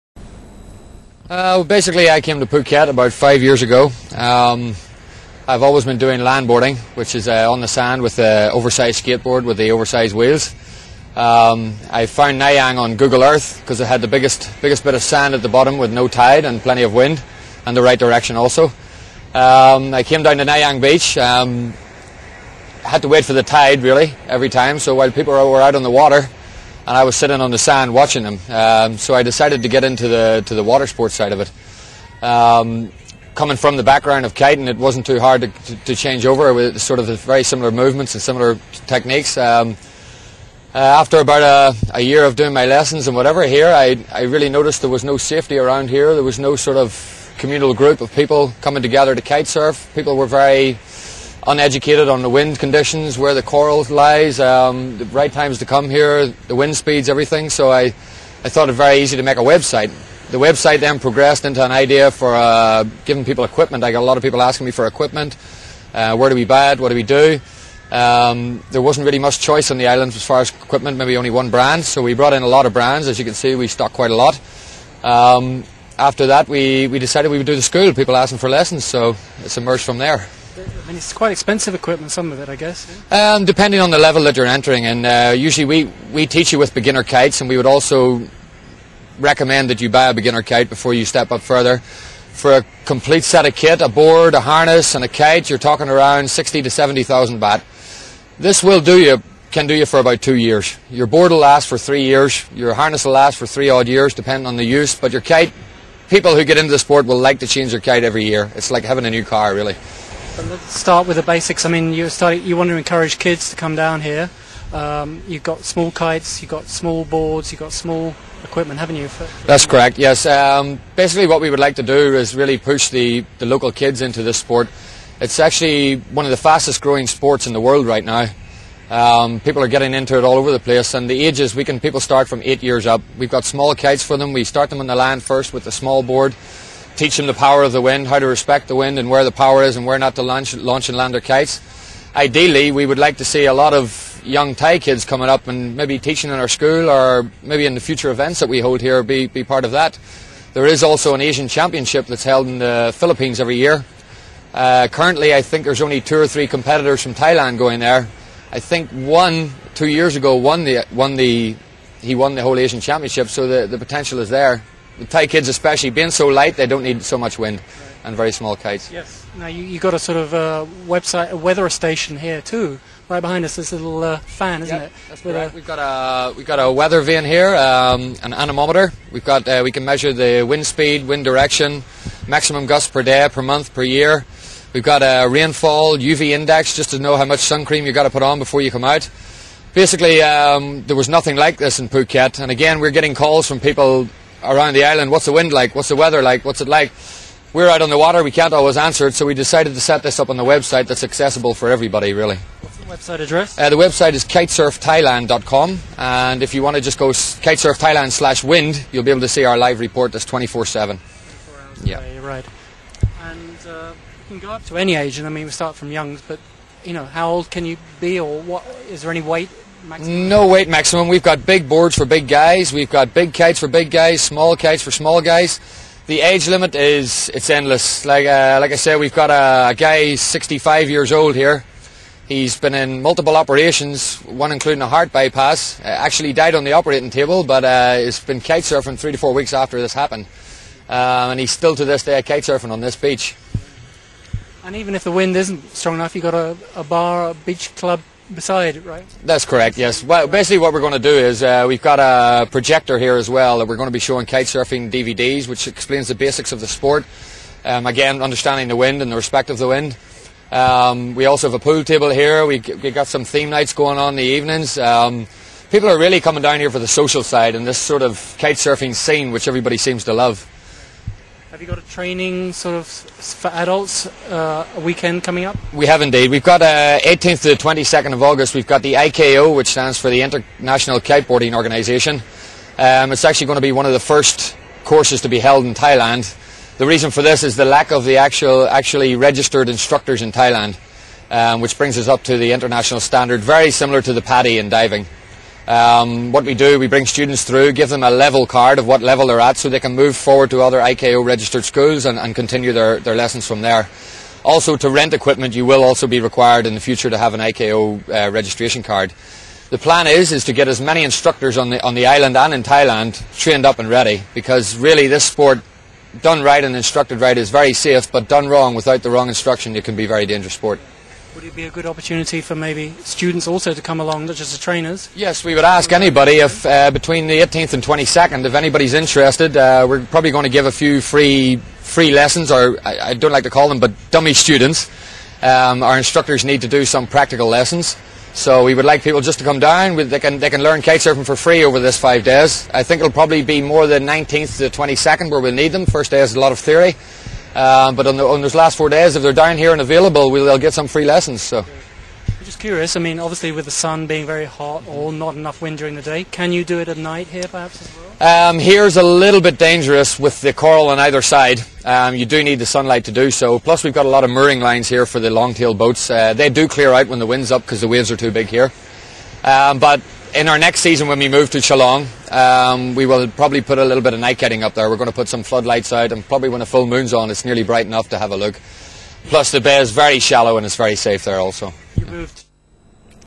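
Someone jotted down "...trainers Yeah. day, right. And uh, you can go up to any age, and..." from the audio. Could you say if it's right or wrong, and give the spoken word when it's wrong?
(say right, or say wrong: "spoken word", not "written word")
wrong: "hours", not "trainers".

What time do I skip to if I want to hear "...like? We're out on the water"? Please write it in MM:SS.
03:16.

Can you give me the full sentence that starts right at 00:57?
So I, I thought it very easy to make a website.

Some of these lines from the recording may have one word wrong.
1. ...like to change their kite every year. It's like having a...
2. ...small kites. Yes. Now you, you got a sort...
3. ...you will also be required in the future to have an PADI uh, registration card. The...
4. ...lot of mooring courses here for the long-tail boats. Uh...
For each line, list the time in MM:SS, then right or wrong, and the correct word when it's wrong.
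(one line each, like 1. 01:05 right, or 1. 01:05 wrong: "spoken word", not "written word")
1. 01:47 right
2. 02:48 right
3. 05:05 wrong: "IKO", not "PADI"
4. 06:04 wrong: "lines", not "courses".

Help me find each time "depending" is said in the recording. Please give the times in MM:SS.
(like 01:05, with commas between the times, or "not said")
01:23, 01:44.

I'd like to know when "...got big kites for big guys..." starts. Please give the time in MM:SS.
03:42.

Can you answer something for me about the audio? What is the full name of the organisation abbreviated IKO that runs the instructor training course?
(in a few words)
International Kiteboarding Organisation.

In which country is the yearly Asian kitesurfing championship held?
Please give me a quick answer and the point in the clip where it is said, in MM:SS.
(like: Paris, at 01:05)
Philippines, at 02:32.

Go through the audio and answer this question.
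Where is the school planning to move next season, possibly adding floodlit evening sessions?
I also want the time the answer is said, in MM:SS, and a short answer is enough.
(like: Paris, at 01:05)
Chalong, at 06:11.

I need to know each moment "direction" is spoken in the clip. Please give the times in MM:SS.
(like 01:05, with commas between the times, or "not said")
00:17, 03:01.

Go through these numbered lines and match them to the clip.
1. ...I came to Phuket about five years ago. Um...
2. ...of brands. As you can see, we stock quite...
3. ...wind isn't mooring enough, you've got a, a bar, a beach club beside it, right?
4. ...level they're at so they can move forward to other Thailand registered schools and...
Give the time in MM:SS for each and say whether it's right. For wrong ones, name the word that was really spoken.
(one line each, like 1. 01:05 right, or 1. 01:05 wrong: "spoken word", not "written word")
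1. 00:02 right
2. 01:12 right
3. 04:05 wrong: "strong", not "mooring"
4. 04:59 wrong: "IKO", not "Thailand".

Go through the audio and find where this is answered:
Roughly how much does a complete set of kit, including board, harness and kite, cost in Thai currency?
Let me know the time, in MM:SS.
01:36.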